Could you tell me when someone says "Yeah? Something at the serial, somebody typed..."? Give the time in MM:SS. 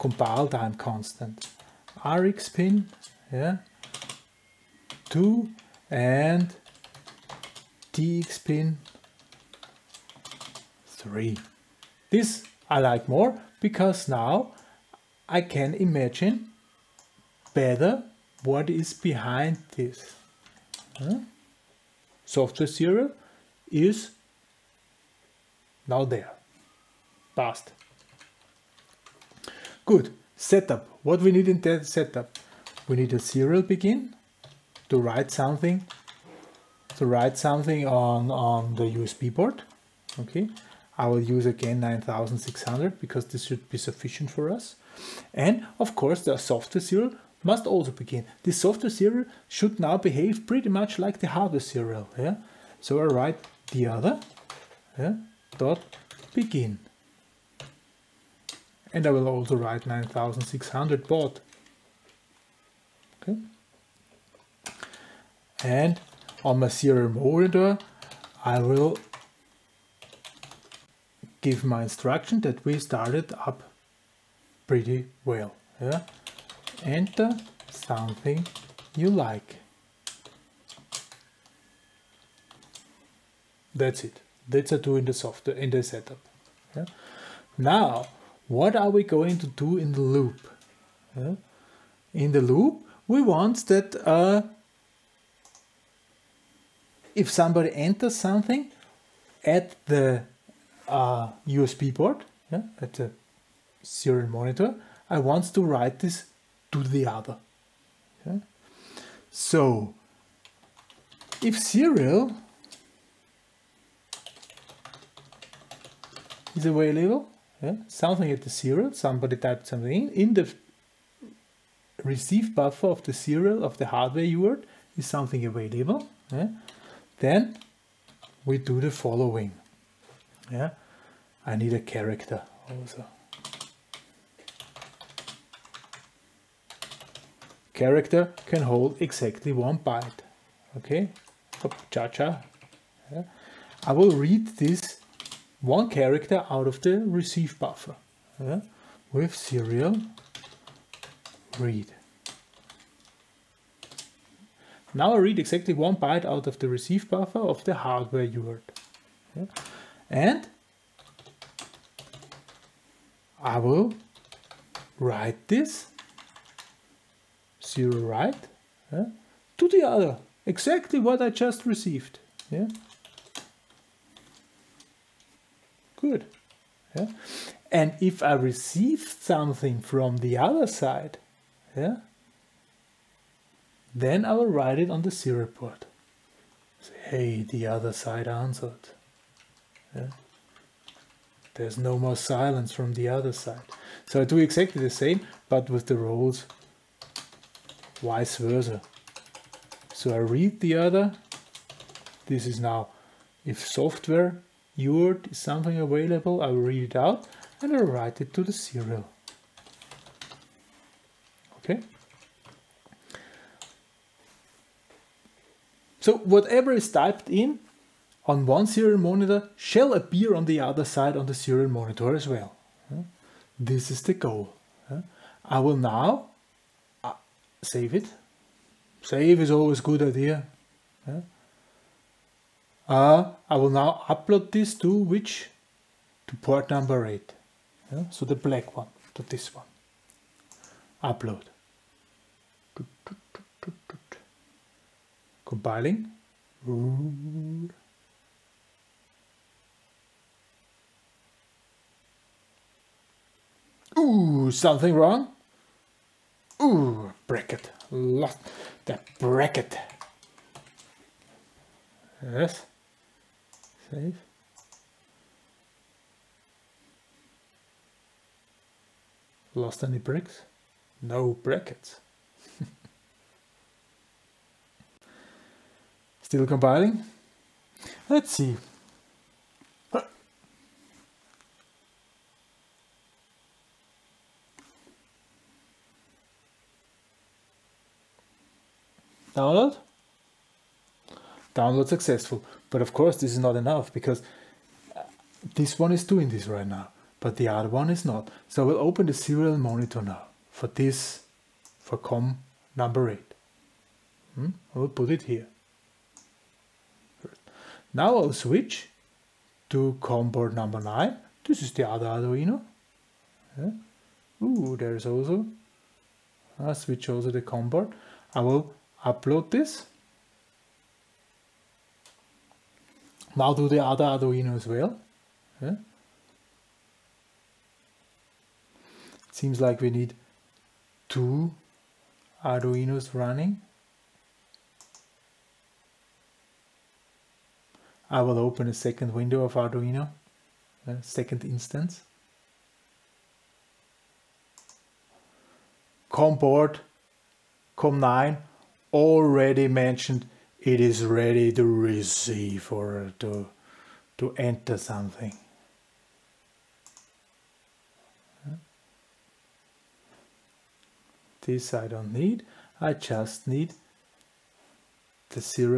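01:57.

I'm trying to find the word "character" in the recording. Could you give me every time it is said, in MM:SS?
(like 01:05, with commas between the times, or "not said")
02:11, 02:17, 02:25.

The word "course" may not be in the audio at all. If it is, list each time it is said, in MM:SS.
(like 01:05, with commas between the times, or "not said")
00:45, 04:52.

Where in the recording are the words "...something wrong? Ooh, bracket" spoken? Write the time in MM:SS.
04:14.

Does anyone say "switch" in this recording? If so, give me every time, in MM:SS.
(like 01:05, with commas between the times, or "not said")
05:08, 05:16.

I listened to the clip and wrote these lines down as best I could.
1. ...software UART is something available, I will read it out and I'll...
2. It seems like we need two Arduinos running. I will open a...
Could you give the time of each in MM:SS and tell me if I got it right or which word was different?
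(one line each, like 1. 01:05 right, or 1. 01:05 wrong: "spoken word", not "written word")
1. 03:23 right
2. 05:29 right.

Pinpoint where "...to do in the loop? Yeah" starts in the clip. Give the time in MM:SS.
01:29.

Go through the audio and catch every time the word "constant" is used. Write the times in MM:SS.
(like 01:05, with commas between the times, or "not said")
00:00.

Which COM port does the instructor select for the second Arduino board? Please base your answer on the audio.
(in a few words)
COM9.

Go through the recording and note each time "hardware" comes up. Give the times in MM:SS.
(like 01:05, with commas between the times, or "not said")
00:51, 02:03, 02:37.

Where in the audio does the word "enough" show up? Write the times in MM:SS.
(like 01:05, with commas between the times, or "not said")
04:53.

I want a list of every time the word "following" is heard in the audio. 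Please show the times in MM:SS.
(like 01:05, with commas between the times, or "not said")
02:08.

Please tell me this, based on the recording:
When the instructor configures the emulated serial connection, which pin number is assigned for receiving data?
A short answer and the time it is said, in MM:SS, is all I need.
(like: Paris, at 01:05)
2, at 00:02.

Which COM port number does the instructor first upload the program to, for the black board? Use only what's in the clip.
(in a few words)
8.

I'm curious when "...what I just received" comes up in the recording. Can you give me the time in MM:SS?
02:50.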